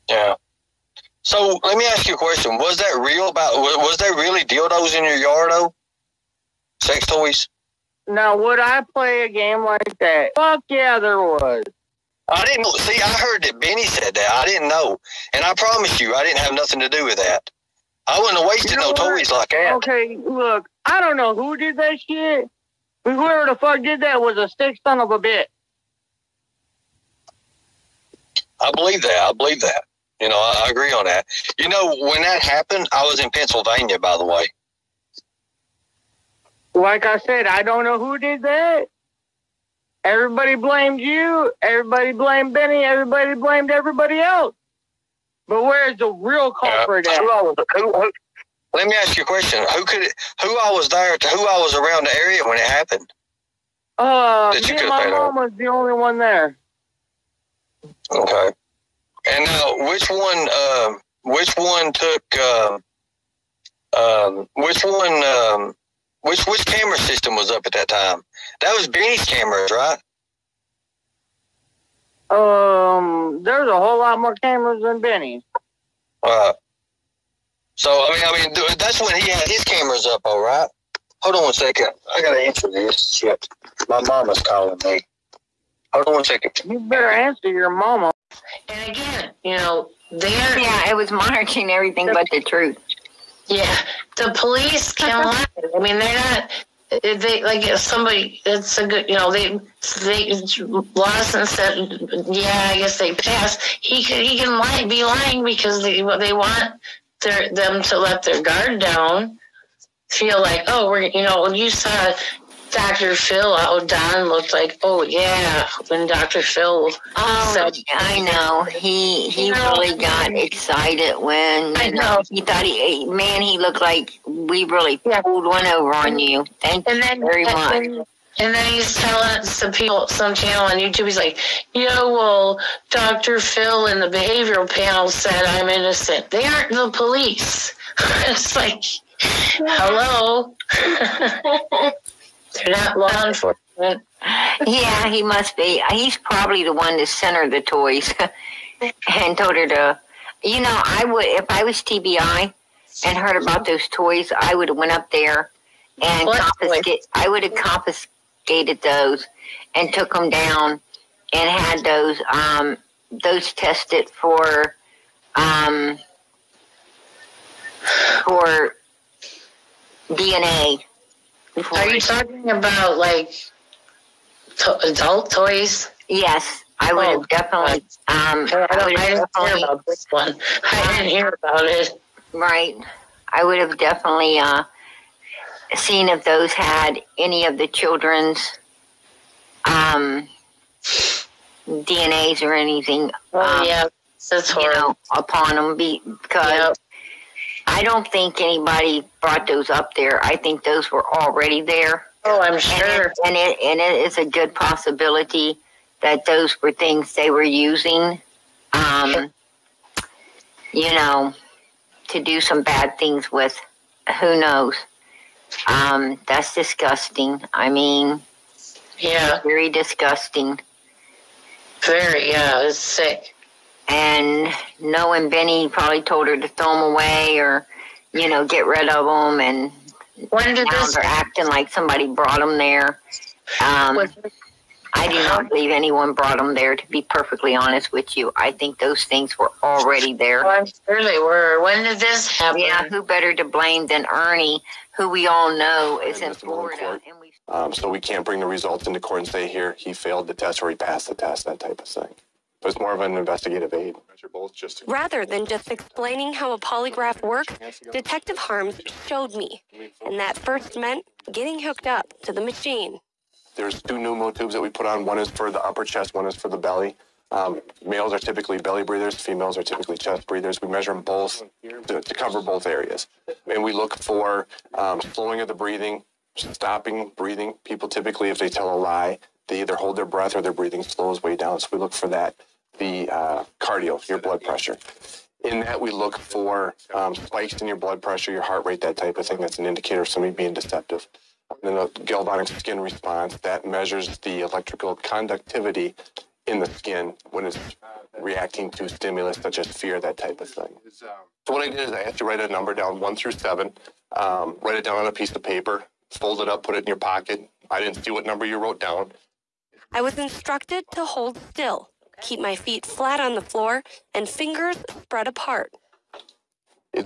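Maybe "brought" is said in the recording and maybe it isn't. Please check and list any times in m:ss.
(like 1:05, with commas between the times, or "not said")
3:19, 3:52, 3:56.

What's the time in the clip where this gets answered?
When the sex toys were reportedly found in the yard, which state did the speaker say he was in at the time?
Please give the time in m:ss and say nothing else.
0:33.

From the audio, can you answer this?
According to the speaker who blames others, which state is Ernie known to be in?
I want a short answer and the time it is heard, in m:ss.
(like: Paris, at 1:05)
Florida, at 4:06.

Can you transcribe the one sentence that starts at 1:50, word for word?
Feel like, oh, we're you know, you saw Dr.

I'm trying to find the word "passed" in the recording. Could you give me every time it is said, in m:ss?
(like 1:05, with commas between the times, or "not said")
1:43, 4:10.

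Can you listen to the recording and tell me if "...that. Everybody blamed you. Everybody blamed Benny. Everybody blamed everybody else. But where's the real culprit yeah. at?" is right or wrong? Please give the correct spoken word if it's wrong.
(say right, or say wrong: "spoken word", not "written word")
right.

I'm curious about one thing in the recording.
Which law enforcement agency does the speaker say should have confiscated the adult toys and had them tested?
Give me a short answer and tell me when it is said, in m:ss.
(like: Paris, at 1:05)
TBI, at 2:31.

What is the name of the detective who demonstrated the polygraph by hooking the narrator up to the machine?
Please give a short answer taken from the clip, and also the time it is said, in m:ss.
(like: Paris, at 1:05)
Harms, at 4:18.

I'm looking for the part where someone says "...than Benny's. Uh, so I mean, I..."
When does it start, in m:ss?
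1:14.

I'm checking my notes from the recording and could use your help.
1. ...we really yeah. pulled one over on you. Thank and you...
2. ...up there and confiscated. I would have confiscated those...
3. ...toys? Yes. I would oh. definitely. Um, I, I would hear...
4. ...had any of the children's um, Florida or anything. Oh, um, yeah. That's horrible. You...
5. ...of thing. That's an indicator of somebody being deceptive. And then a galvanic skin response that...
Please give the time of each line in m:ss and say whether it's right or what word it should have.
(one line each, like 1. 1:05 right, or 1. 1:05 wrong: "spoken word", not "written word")
1. 2:04 right
2. 2:34 right
3. 2:55 right
4. 3:06 wrong: "DNAs", not "Florida"
5. 4:49 right.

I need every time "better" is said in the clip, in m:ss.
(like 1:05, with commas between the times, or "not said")
1:26, 4:03.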